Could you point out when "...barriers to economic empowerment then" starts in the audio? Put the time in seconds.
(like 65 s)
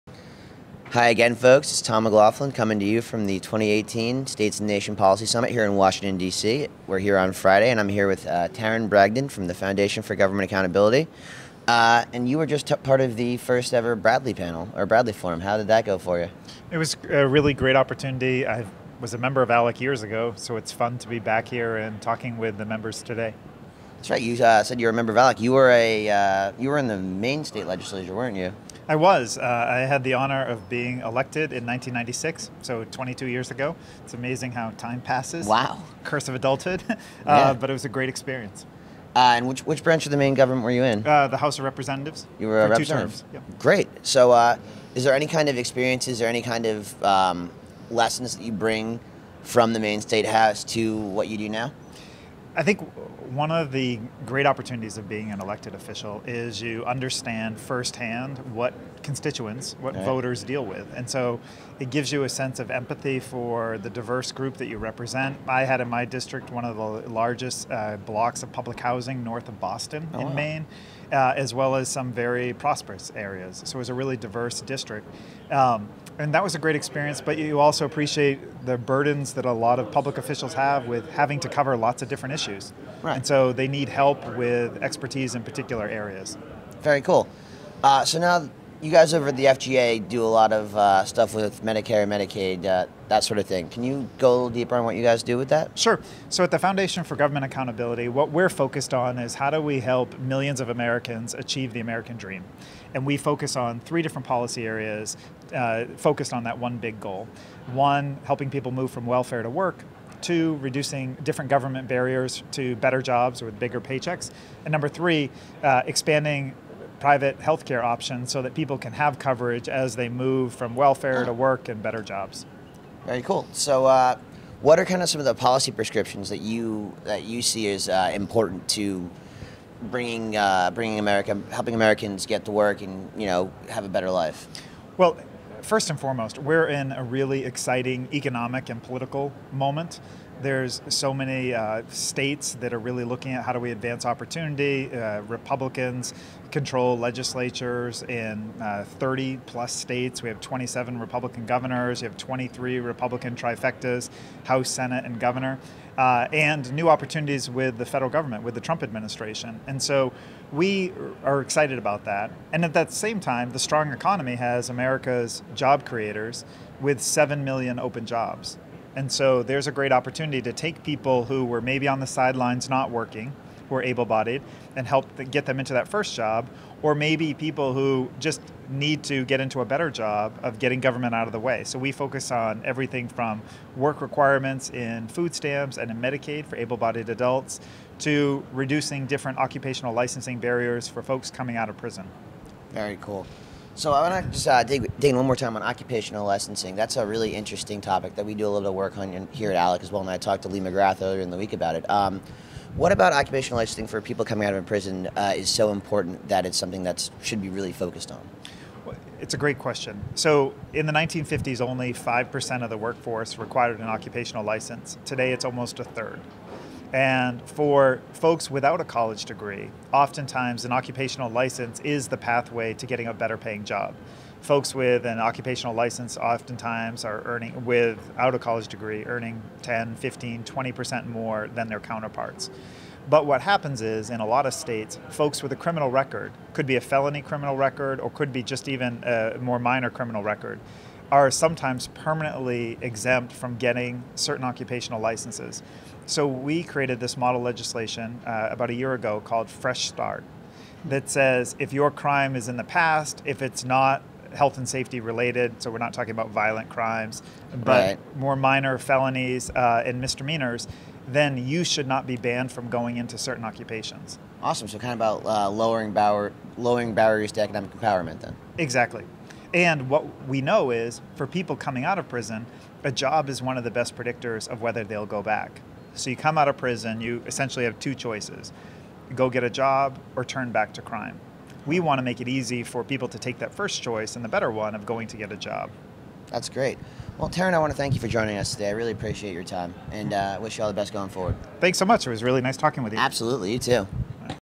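266 s.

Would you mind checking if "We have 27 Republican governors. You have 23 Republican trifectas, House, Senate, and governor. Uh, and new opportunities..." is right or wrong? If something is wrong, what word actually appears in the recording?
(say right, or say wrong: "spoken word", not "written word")
right.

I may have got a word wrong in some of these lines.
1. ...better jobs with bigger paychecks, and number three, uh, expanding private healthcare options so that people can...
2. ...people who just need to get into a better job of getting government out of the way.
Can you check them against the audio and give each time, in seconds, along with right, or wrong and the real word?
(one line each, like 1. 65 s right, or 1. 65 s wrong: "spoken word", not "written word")
1. 112 s right
2. 177 s right.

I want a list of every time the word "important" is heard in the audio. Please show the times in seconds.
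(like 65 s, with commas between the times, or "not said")
128 s, 205 s.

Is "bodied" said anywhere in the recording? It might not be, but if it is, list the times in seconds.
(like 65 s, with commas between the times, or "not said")
174 s, 186 s.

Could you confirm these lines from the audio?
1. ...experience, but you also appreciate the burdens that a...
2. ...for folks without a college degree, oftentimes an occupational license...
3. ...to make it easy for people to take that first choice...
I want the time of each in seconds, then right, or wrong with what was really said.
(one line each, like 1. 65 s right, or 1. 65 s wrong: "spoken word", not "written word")
1. 76 s right
2. 217 s right
3. 281 s right.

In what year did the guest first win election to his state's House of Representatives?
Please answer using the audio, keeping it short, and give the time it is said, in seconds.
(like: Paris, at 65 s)
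1996, at 31 s.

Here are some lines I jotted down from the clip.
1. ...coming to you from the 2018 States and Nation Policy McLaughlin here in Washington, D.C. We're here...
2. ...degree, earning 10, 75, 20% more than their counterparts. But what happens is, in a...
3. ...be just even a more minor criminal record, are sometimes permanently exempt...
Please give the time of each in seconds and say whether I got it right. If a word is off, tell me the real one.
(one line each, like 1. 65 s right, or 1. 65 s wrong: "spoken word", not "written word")
1. 2 s wrong: "Summit", not "McLaughlin"
2. 228 s wrong: "15", not "75"
3. 238 s right.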